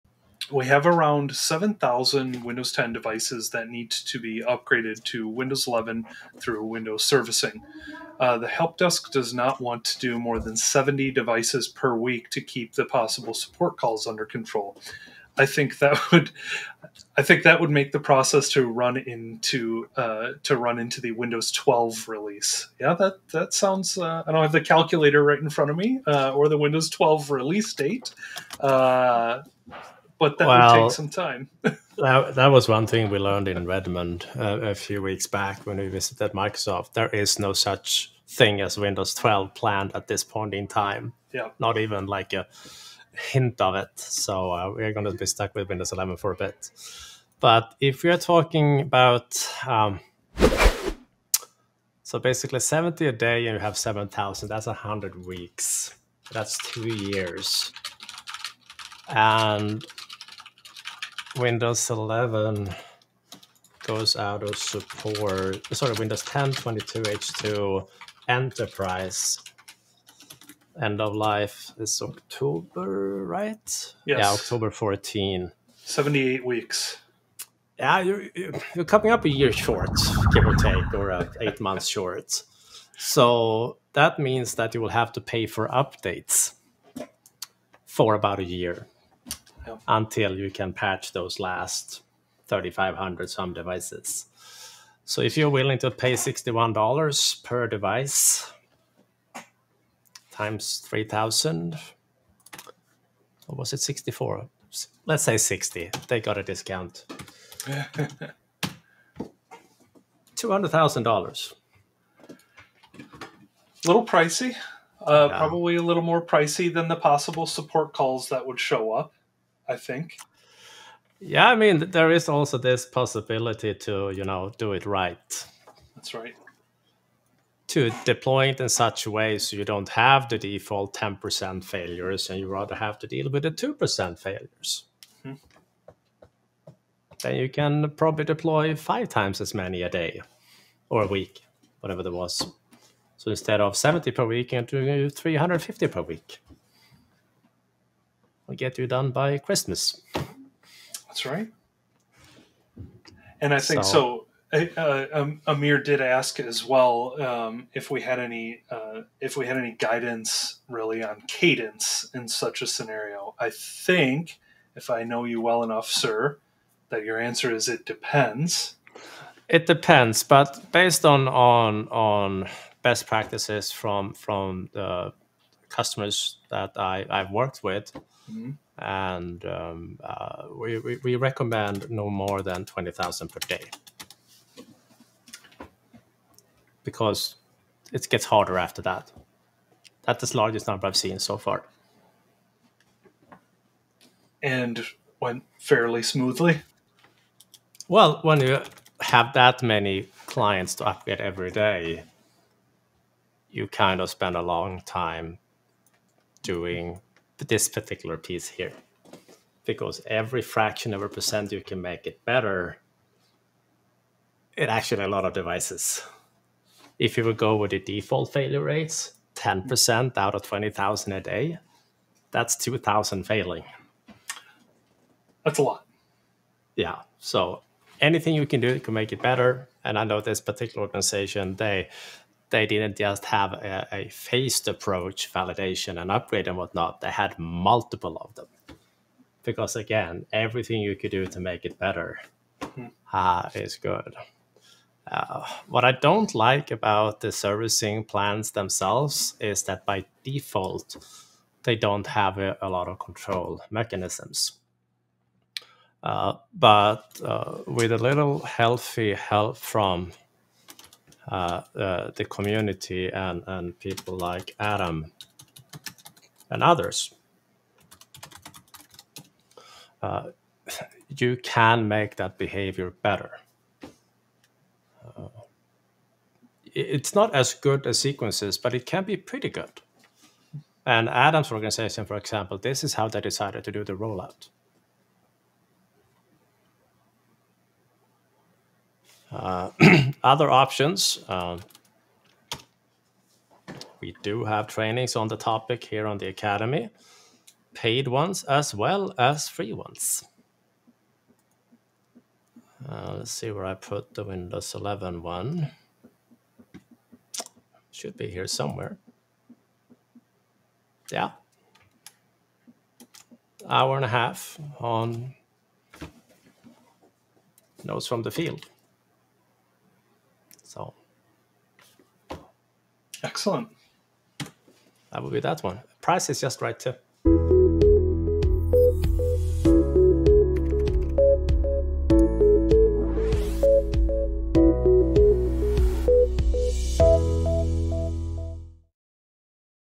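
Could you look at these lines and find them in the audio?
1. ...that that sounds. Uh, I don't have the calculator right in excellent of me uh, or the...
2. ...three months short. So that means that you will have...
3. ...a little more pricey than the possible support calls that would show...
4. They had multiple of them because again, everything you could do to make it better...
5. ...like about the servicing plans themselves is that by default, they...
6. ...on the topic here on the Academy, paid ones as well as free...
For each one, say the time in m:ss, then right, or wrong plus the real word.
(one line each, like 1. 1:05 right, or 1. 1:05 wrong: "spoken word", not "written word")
1. 0:22 wrong: "front", not "excellent"
2. 1:21 wrong: "eight", not "three"
3. 1:55 right
4. 3:57 right
5. 4:06 right
6. 4:55 right.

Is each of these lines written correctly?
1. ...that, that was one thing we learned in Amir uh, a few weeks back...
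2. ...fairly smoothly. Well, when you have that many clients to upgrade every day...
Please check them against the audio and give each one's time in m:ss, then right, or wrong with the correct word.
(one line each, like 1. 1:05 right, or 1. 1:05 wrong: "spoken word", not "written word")
1. 0:31 wrong: "Redmond", not "Amir"
2. 3:15 right.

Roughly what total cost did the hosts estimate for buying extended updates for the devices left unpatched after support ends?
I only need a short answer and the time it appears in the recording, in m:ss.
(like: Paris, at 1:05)
$200,000, at 1:50.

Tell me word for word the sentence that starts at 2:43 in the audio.
I think, if I know you well enough, sir, that your answer is it depends.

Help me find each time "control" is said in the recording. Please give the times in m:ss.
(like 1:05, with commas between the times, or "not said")
0:14, 4:12.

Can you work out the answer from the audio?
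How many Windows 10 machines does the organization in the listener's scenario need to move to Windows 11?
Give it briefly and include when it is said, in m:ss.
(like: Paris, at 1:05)
7,000, at 0:01.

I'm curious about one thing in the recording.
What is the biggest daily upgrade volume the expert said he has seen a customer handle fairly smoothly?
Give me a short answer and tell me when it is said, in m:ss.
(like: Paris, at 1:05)
20,000 per day, at 3:02.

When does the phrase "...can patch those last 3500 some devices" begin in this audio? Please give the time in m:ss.
1:30.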